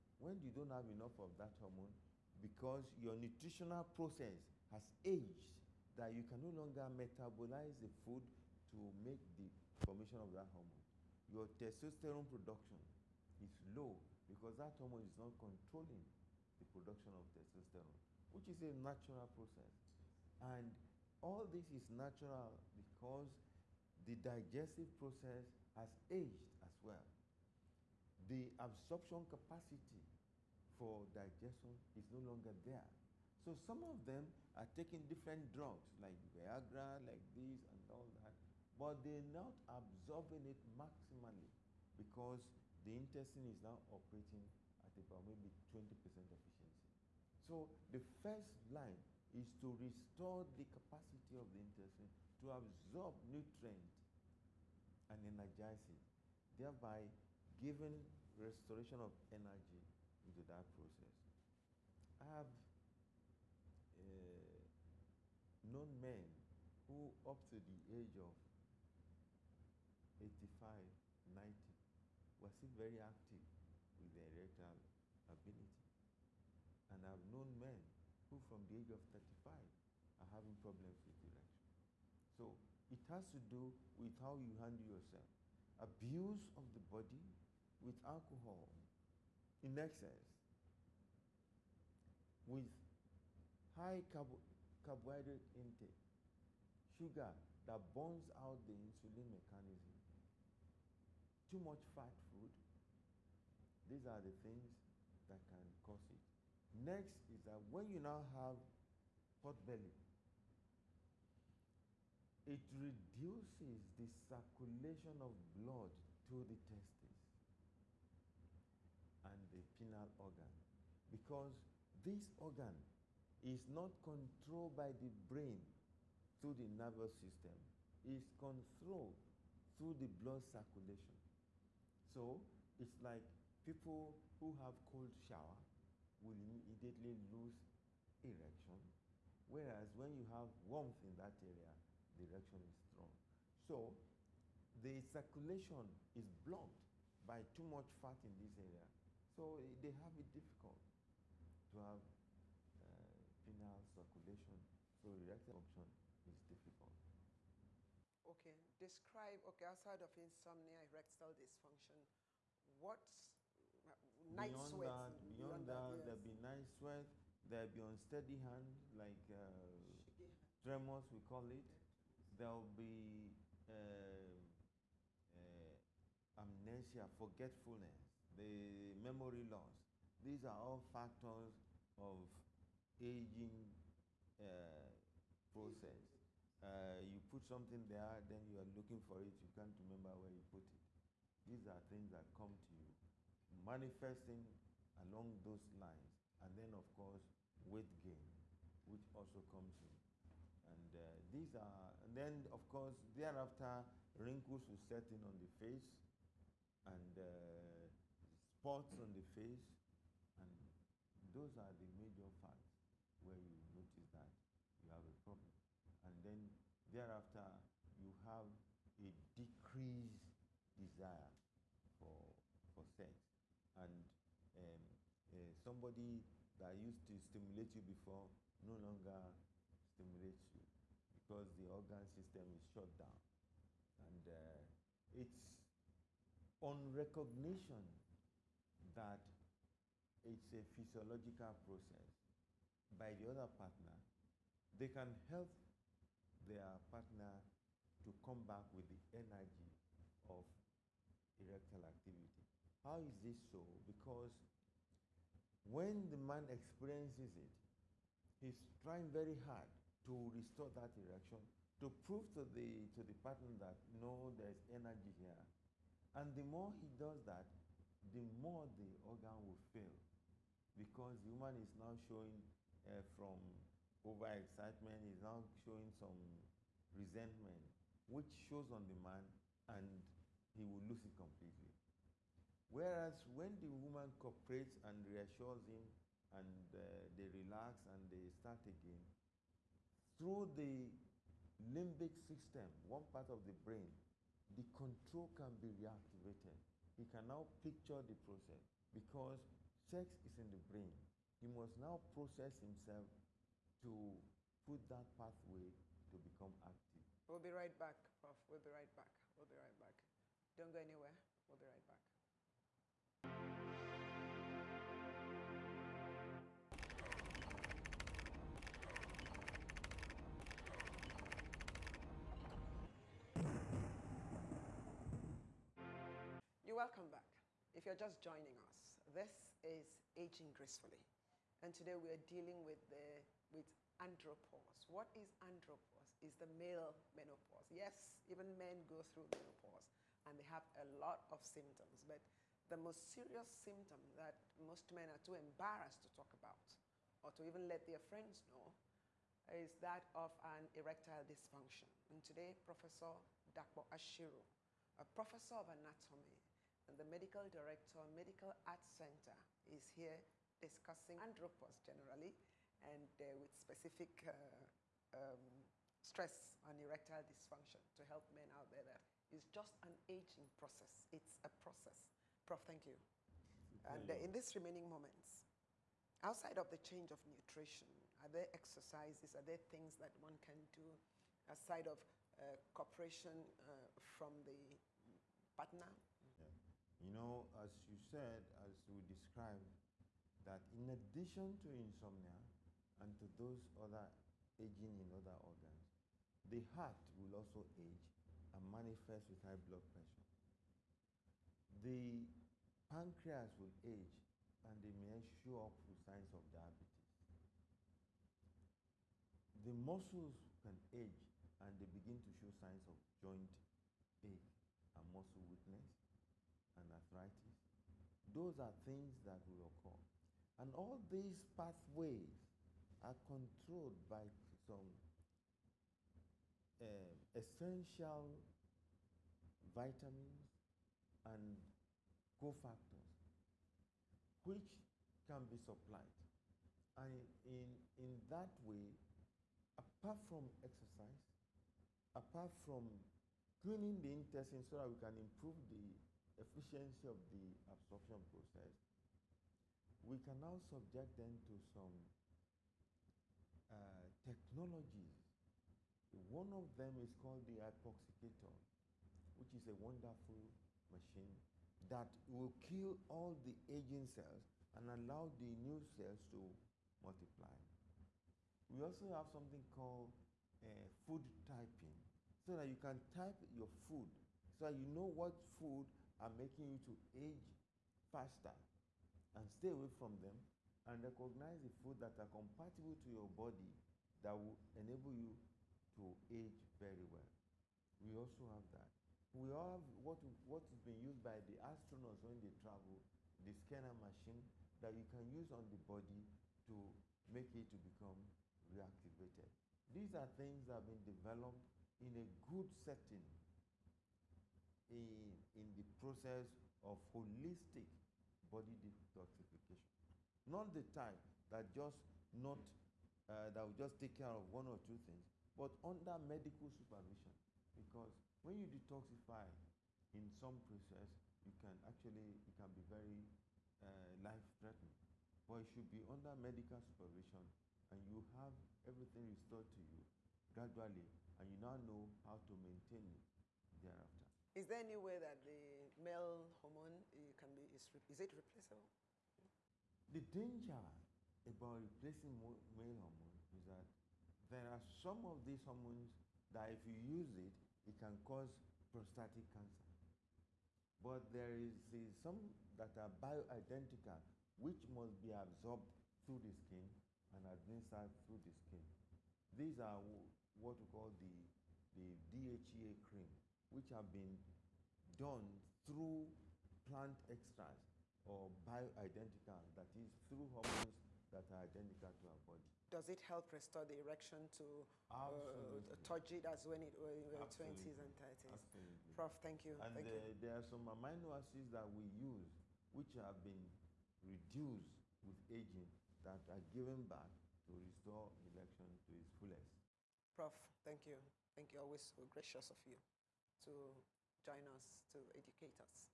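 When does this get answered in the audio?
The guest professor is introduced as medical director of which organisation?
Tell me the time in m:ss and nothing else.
5:58.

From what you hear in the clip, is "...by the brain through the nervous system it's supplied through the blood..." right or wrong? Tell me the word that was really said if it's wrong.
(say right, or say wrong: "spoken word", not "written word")
wrong: "controlled", not "supplied".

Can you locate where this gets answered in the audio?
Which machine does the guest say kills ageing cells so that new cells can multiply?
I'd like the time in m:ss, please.
7:37.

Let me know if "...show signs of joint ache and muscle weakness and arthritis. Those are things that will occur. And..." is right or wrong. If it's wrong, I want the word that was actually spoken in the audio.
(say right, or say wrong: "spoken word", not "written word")
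right.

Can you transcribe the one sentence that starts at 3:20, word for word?
And uh, these are, and then, of course, thereafter, wrinkles will set in on the face and uh, spots on the face.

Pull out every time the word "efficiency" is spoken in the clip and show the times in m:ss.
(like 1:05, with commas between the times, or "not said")
0:45, 7:26.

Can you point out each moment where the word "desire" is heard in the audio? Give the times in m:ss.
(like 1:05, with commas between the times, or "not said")
3:40.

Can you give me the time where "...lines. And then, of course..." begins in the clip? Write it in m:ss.
3:15.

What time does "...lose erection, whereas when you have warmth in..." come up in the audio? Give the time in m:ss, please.
2:17.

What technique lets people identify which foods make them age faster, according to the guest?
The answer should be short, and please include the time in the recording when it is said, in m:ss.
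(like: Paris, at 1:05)
food typing, at 7:51.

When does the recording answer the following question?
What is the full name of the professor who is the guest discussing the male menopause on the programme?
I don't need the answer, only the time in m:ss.
5:53.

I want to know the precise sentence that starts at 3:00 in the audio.
These are all factors of aging uh, process.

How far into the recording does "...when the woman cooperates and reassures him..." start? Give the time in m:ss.
4:43.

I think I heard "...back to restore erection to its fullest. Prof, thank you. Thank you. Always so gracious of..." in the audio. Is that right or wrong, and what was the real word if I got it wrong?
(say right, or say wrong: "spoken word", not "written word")
right.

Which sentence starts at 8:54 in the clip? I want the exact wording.
Is there any way that the male hormone eh, can be, is, is it replaceable?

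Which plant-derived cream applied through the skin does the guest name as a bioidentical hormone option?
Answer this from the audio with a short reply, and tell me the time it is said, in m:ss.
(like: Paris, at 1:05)
DHEA cream, at 9:22.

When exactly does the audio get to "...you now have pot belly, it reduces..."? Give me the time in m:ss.
1:47.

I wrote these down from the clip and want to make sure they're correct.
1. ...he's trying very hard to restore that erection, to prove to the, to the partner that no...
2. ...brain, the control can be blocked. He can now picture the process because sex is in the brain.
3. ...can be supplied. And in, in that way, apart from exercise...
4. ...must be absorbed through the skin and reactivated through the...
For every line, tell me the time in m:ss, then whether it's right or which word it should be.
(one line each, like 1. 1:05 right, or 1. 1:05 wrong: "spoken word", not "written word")
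1. 4:18 right
2. 4:53 wrong: "reactivated", not "blocked"
3. 7:15 right
4. 9:14 wrong: "administered", not "reactivated".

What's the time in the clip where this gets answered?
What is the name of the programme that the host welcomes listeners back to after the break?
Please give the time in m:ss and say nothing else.
5:30.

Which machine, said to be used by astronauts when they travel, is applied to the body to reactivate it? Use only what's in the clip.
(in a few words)
SCENAR.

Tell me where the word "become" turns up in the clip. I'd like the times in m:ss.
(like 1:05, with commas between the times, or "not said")
5:06, 8:17.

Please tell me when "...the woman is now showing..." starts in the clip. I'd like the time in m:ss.
4:31.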